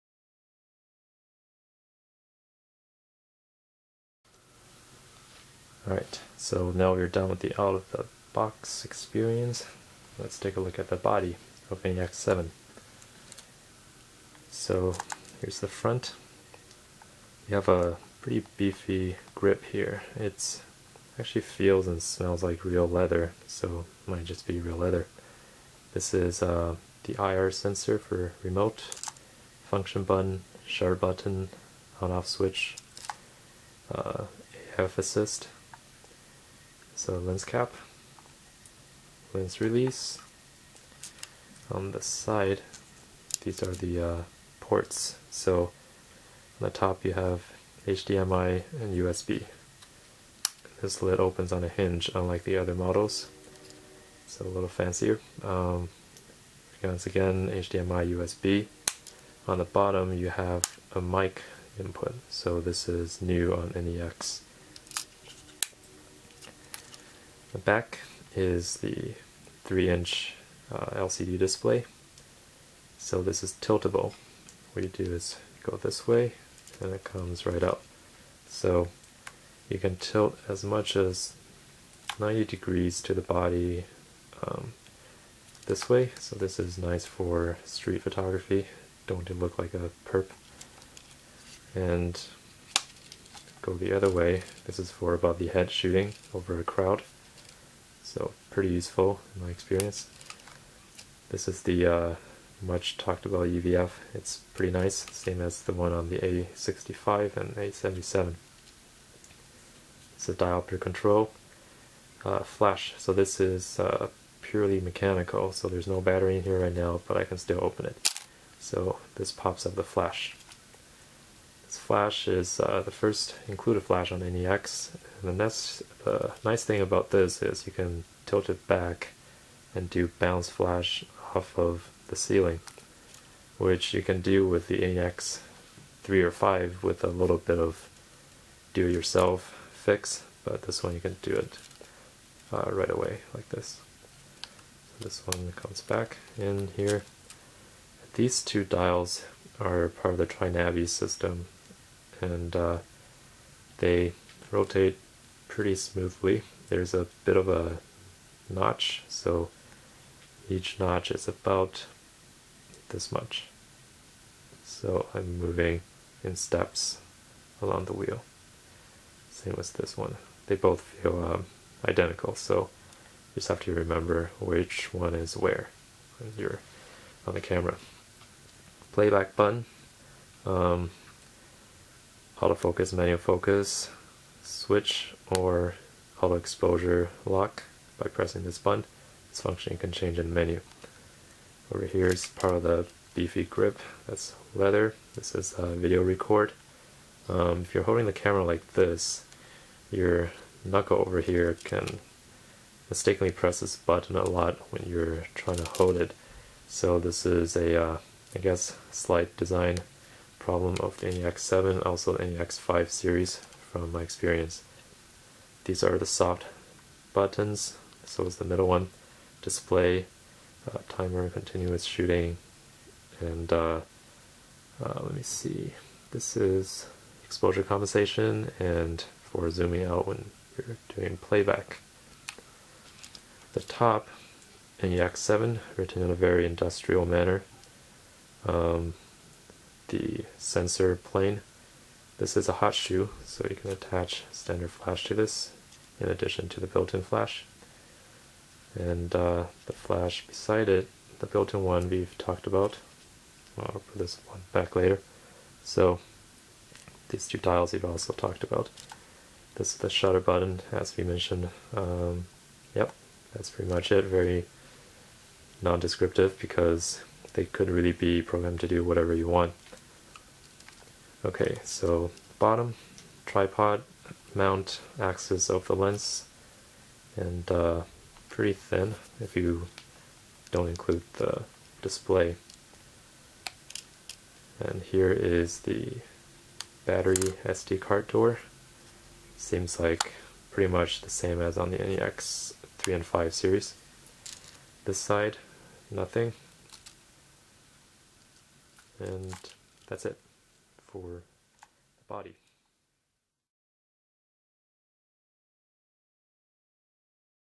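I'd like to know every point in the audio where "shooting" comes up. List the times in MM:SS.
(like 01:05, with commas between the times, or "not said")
01:35, 03:41.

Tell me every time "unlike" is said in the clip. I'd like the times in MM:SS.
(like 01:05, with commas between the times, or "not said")
00:52.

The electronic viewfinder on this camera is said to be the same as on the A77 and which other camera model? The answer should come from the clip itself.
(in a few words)
A65.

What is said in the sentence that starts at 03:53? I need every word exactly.
The top NEX 7, written in a very industrial manner.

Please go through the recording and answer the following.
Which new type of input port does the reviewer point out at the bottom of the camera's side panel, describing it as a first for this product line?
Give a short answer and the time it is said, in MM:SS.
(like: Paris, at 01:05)
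mic input, at 01:01.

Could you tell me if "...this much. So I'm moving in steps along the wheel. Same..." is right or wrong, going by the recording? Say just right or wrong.
right.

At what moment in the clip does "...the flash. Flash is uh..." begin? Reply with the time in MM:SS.
01:59.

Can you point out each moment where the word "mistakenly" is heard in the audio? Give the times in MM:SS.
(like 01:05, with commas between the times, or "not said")
03:22.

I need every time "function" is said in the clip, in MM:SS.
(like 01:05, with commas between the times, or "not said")
00:29, 03:09.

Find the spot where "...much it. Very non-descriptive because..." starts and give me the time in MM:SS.
04:23.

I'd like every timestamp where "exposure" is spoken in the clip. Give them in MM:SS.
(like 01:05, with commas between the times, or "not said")
03:06, 03:47.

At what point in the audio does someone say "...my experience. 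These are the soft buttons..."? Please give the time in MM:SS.
03:33.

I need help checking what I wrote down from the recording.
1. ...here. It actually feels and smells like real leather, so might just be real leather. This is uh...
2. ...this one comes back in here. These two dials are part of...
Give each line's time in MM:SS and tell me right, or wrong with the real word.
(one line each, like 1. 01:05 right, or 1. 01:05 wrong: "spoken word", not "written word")
1. 00:19 right
2. 02:25 right.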